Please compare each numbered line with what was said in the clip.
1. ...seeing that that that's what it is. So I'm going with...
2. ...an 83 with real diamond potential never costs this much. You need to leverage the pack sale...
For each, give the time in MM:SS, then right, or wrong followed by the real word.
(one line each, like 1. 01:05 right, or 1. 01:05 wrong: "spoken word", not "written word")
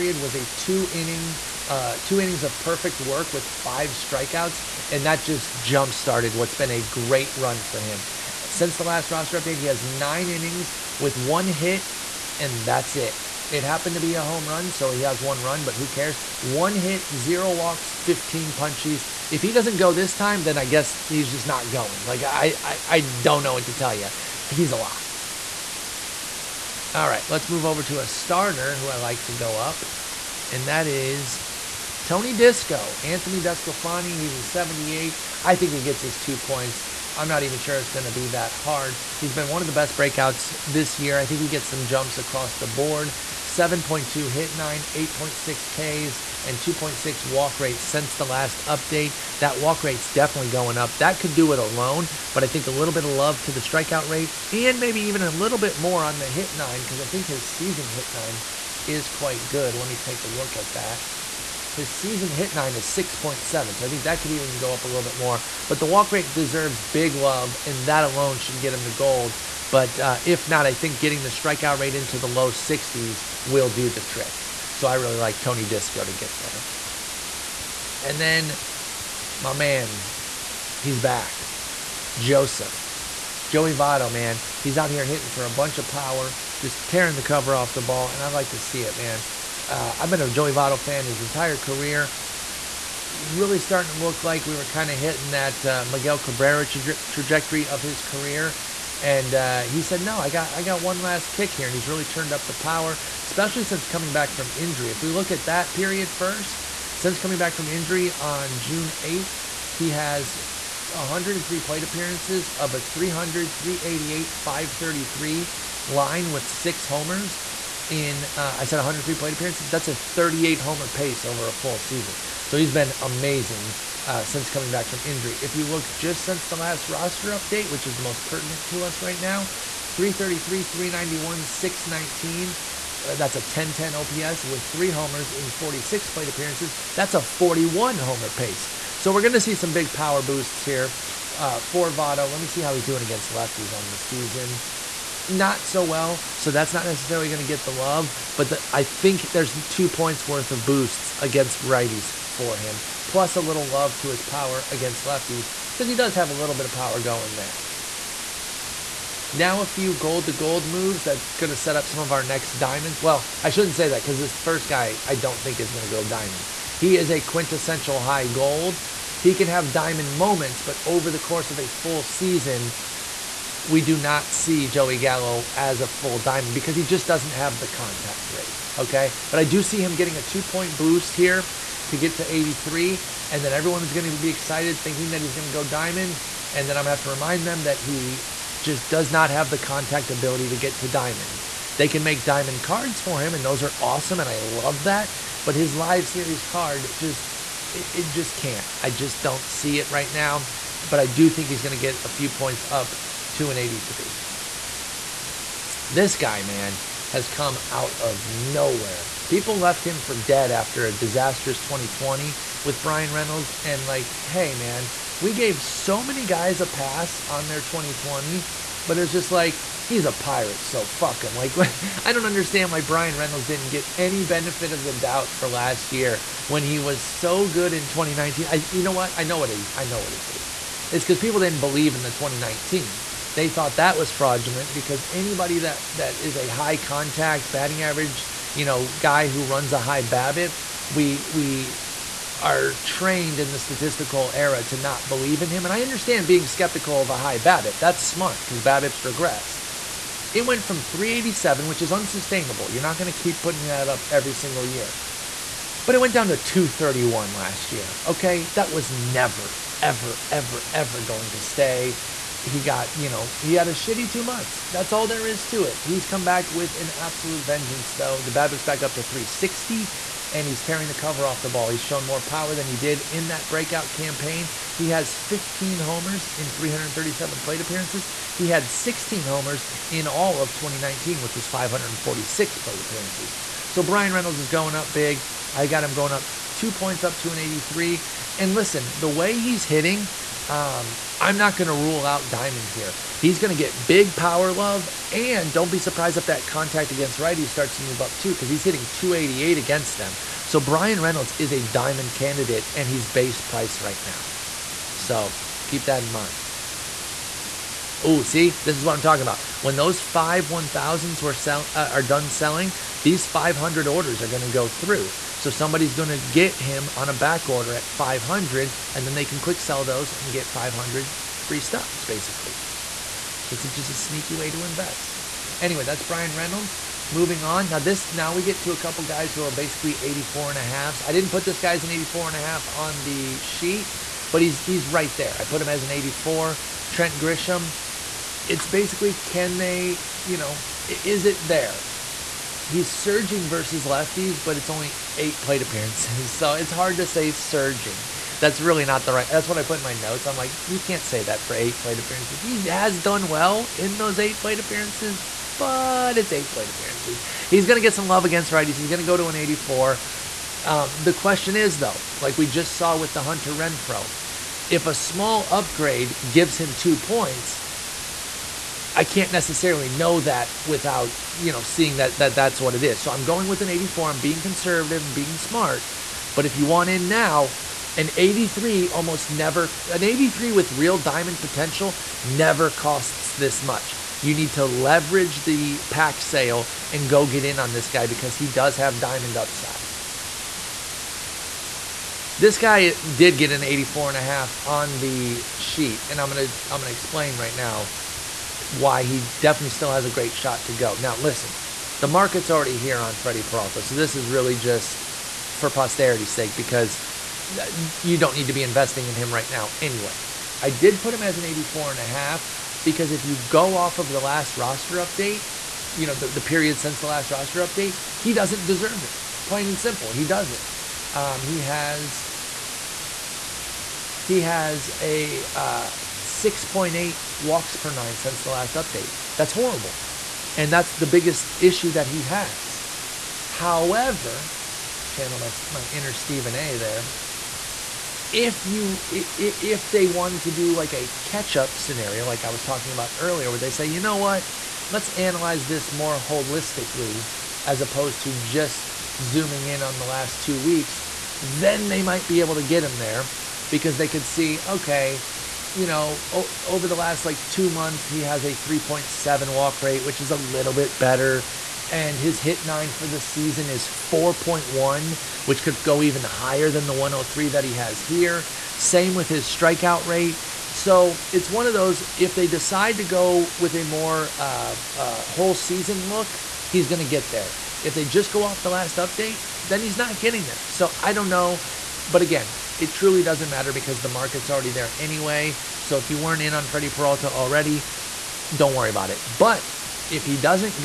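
1. 06:11 right
2. 06:19 right.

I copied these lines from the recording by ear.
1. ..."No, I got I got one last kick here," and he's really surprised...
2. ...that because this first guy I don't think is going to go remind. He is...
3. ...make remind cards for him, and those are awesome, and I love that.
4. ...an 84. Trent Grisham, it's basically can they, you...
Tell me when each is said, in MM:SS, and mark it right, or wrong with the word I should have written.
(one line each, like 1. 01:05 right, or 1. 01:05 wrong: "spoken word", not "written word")
1. 01:40 wrong: "turned", not "surprised"
2. 02:43 wrong: "diamond", not "remind"
3. 03:12 wrong: "diamond", not "remind"
4. 05:35 right.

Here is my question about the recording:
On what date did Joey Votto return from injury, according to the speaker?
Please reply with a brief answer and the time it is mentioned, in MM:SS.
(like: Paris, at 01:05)
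June 8, at 01:48.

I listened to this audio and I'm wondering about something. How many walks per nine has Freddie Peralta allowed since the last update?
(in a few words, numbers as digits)
6.8.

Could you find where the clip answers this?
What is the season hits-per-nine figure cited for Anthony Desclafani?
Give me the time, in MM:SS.
01:02.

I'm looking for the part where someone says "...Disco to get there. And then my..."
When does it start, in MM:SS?
01:15.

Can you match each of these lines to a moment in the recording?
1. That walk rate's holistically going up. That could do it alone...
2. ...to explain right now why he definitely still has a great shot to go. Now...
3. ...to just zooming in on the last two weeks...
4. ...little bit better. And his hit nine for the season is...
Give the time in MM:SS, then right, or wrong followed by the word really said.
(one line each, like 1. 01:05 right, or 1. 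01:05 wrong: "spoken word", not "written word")
1. 00:49 wrong: "definitely", not "holistically"
2. 06:36 right
3. 07:28 right
4. 07:40 right.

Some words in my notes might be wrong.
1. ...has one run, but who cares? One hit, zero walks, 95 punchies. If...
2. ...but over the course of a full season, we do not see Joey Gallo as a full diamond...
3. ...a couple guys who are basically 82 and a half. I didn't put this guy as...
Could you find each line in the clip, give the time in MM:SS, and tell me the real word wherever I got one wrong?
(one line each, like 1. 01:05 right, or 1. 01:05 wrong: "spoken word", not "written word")
1. 00:15 wrong: "15", not "95"
2. 02:50 right
3. 05:28 wrong: "84", not "82".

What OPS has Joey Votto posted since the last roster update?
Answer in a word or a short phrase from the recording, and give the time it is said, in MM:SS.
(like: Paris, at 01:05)
1010, at 02:13.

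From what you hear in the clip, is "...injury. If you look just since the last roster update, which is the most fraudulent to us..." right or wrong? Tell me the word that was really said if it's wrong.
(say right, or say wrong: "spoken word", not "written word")
wrong: "pertinent", not "fraudulent".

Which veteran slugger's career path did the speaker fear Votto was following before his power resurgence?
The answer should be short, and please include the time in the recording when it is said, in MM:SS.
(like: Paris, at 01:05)
Miguel Cabrera, at 01:35.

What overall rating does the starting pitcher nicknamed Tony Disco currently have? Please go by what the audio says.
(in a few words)
78.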